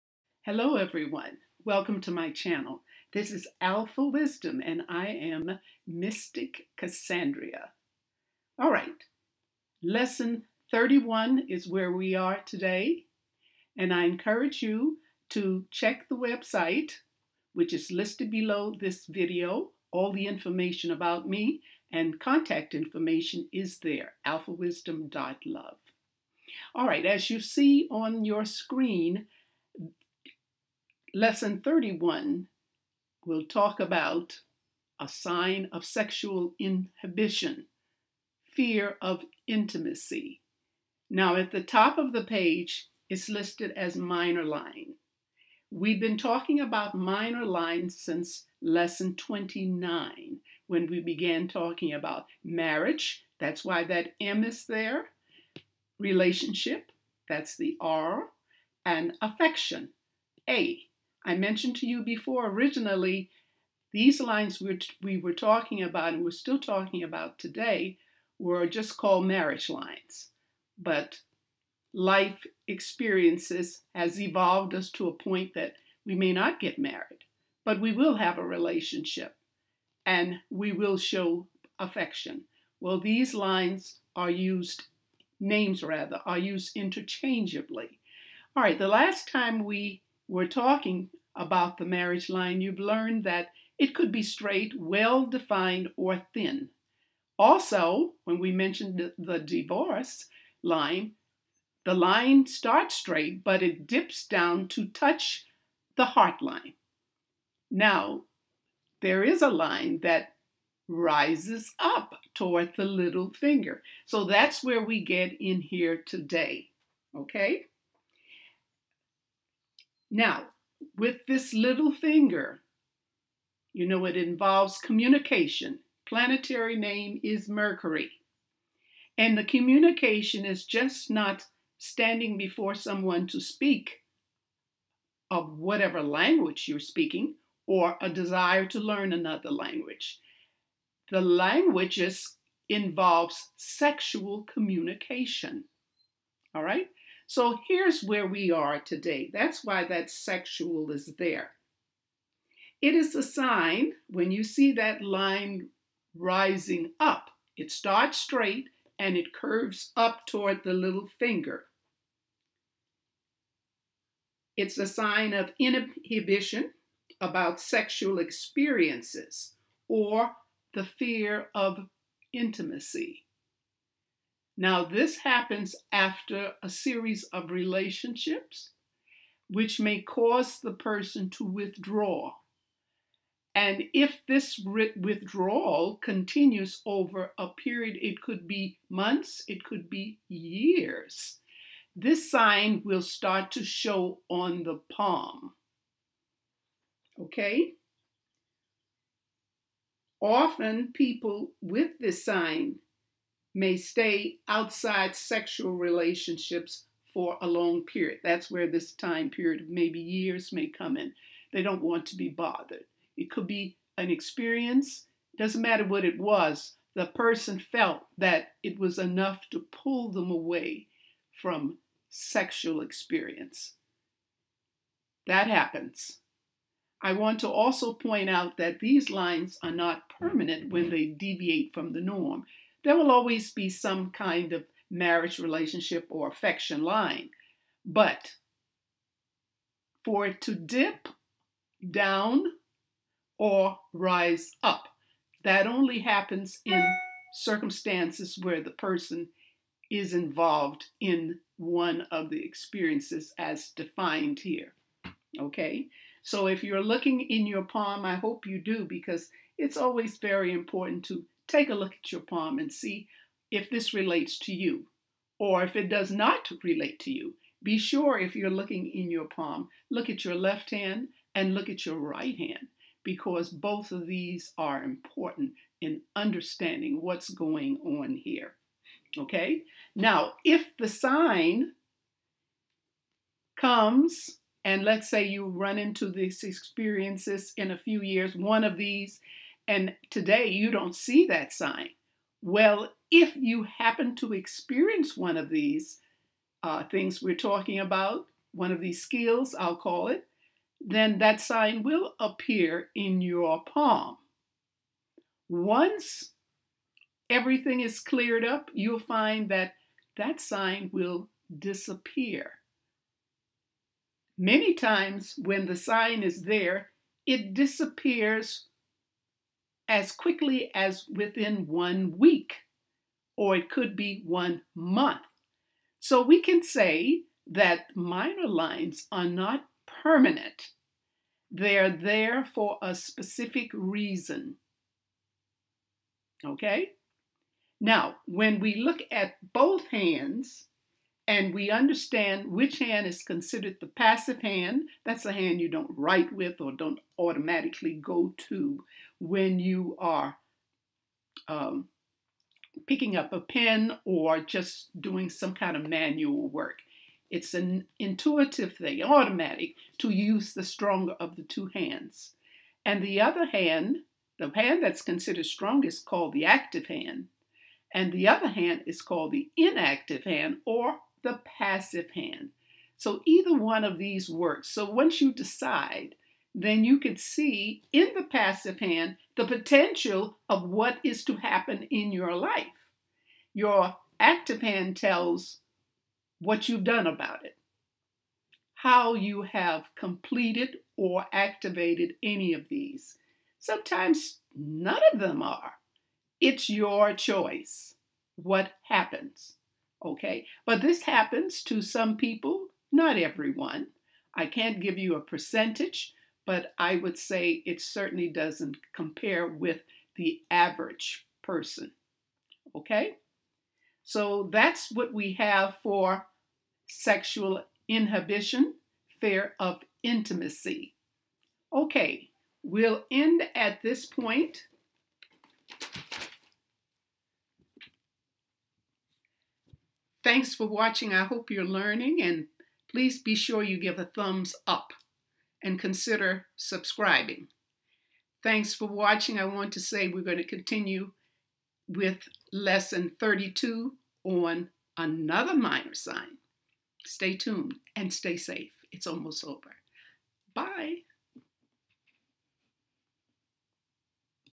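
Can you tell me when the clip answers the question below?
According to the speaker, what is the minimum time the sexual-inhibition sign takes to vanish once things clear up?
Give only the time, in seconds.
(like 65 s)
321 s.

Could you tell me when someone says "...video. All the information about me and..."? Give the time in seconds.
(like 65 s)
19 s.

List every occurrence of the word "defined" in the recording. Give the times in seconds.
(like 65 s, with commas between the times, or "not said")
95 s, 253 s.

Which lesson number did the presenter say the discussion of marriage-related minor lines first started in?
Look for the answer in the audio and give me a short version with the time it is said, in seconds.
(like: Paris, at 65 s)
29, at 48 s.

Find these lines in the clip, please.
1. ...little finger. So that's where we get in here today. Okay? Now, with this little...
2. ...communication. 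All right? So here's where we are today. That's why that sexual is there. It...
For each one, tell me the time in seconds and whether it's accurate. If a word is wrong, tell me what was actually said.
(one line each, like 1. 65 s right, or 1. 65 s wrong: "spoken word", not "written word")
1. 112 s right
2. 144 s right.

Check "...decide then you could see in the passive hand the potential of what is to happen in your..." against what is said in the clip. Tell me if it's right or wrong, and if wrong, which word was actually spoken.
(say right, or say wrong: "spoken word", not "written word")
right.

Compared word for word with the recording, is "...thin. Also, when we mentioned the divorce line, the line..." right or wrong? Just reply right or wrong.
right.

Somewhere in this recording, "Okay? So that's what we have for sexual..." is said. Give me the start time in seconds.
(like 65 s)
412 s.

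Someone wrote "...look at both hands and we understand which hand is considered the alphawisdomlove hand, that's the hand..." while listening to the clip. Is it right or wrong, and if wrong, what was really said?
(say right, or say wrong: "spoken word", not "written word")
wrong: "passive", not "alphawisdomlove".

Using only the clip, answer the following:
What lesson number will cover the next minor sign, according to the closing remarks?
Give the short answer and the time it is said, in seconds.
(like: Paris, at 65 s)
32, at 442 s.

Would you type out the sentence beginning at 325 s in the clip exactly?
So we can say that minor lines are not permanent.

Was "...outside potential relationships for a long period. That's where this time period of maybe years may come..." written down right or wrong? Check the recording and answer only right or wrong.
wrong.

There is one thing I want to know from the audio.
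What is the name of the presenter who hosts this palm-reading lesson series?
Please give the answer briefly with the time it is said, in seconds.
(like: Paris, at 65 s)
Mystic Cassandria, at 5 s.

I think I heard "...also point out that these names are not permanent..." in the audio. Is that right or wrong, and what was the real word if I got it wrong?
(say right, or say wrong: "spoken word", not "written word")
wrong: "lines", not "names".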